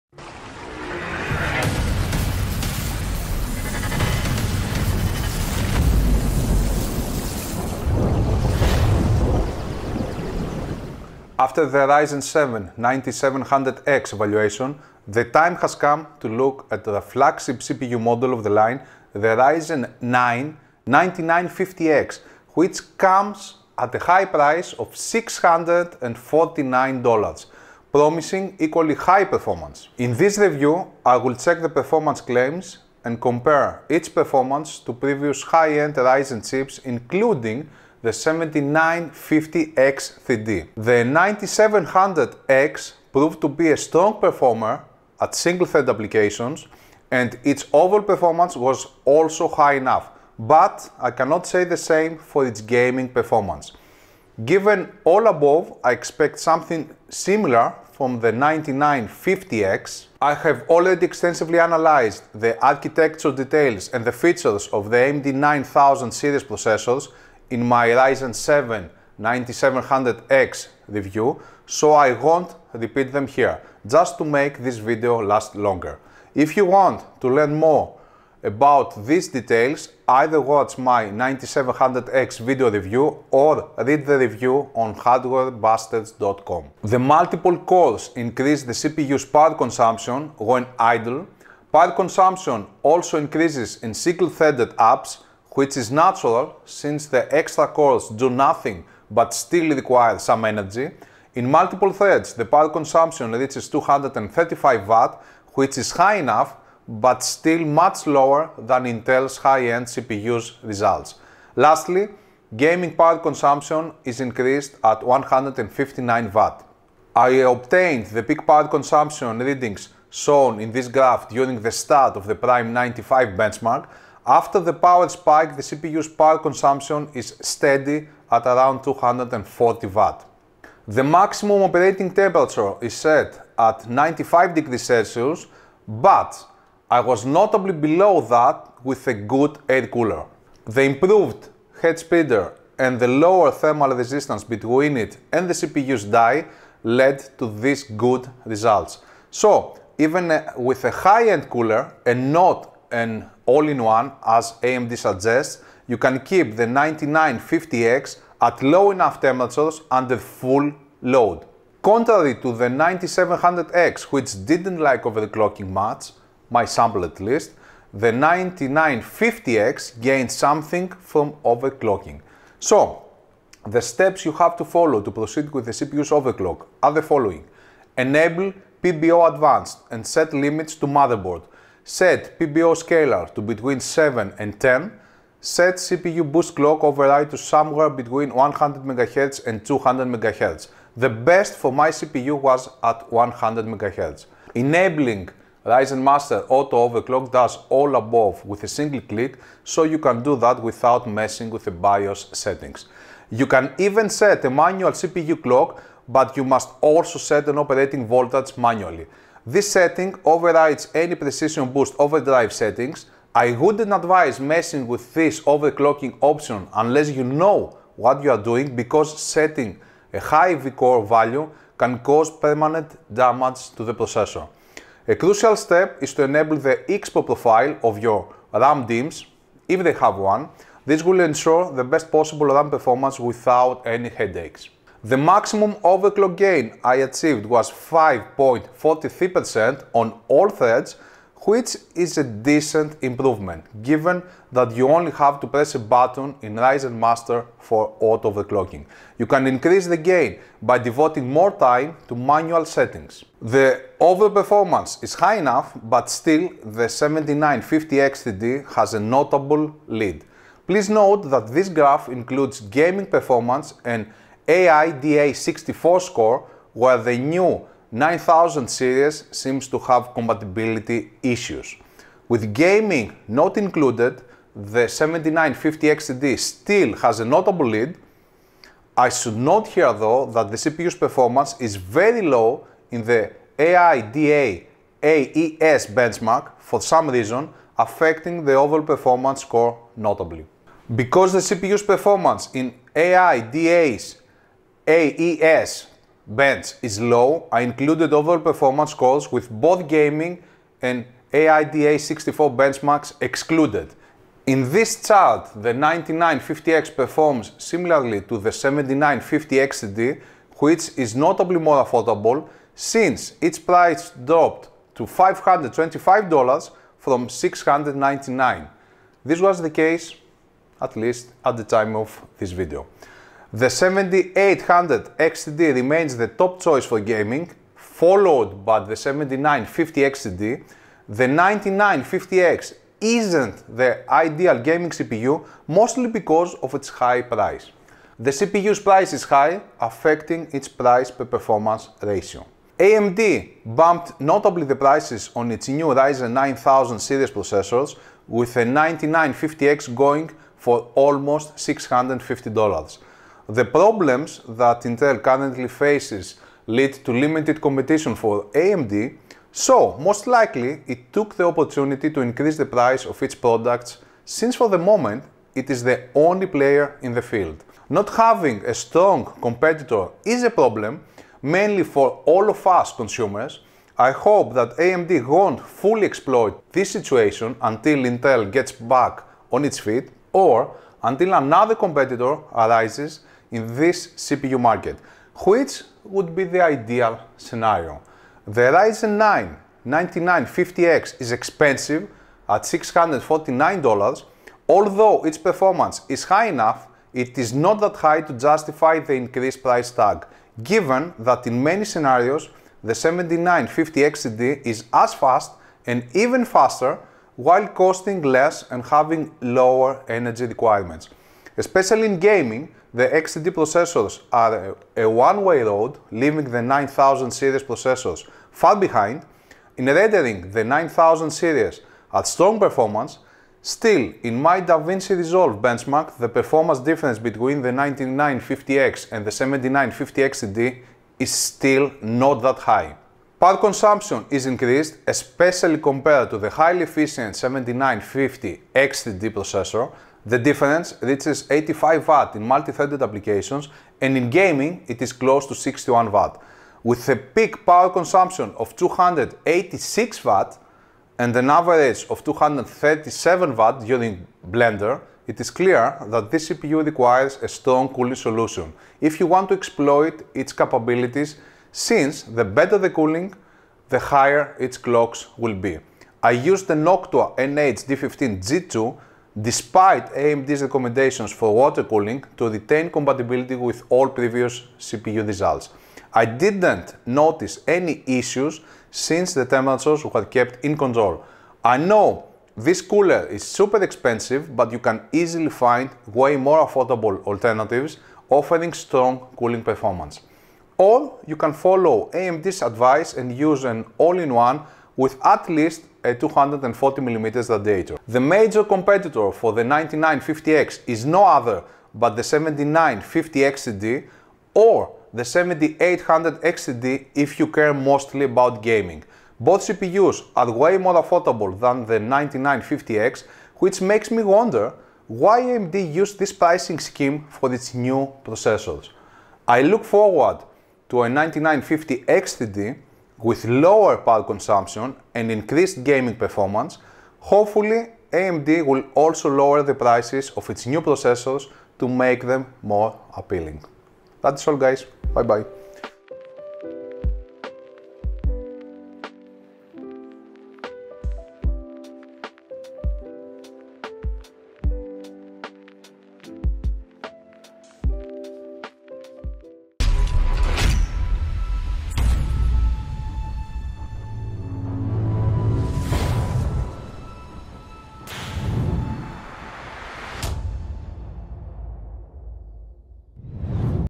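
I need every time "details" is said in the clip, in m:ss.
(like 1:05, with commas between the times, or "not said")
1:03, 1:19.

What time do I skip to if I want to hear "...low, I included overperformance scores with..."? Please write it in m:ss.
4:56.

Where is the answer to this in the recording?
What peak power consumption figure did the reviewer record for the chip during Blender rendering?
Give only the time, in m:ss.
7:28.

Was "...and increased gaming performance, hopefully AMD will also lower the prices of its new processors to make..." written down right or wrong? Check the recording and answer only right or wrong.
right.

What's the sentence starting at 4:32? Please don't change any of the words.
With gaming not included, the 7950X3D still has a notable lead.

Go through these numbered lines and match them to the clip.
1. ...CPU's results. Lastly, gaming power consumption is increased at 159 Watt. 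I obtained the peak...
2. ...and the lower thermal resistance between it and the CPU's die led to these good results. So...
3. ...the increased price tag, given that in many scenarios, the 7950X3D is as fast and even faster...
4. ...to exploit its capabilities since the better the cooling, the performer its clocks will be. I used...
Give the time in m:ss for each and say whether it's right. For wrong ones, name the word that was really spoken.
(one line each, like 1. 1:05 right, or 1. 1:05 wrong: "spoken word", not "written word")
1. 1:49 right
2. 2:22 right
3. 6:38 right
4. 7:39 wrong: "higher", not "performer".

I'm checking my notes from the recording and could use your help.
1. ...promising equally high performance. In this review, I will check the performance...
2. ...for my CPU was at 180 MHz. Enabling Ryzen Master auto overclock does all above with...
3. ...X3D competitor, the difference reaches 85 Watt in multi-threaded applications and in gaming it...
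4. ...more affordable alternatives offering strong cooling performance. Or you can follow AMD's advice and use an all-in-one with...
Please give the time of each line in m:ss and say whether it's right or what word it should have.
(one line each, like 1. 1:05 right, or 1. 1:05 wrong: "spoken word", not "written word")
1. 0:27 right
2. 3:11 wrong: "100", not "180"
3. 7:18 wrong: "processor", not "competitor"
4. 8:06 right.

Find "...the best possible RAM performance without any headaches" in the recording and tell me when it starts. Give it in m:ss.
3:51.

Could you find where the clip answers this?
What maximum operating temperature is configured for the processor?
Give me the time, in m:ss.
2:13.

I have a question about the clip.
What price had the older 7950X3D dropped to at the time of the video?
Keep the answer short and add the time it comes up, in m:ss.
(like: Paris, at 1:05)
$525, at 5:15.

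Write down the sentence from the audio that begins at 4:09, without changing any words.
You can increase the gain by devoting more time to manual settings.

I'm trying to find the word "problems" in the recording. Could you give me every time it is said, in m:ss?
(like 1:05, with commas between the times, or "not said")
5:53, 6:10.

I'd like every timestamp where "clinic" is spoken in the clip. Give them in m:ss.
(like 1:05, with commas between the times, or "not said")
not said.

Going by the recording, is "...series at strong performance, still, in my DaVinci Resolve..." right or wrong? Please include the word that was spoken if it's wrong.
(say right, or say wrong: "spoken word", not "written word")
right.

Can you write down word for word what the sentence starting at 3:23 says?
You can even set a manual CPU clock, but you must also set an operating voltage manually.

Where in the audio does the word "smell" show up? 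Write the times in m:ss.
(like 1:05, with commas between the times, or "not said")
not said.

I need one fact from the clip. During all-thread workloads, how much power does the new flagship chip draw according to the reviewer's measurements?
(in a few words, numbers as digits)
235 Watt.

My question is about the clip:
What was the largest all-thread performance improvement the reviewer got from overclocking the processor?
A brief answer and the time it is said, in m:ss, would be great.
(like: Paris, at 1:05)
5.43%, at 3:57.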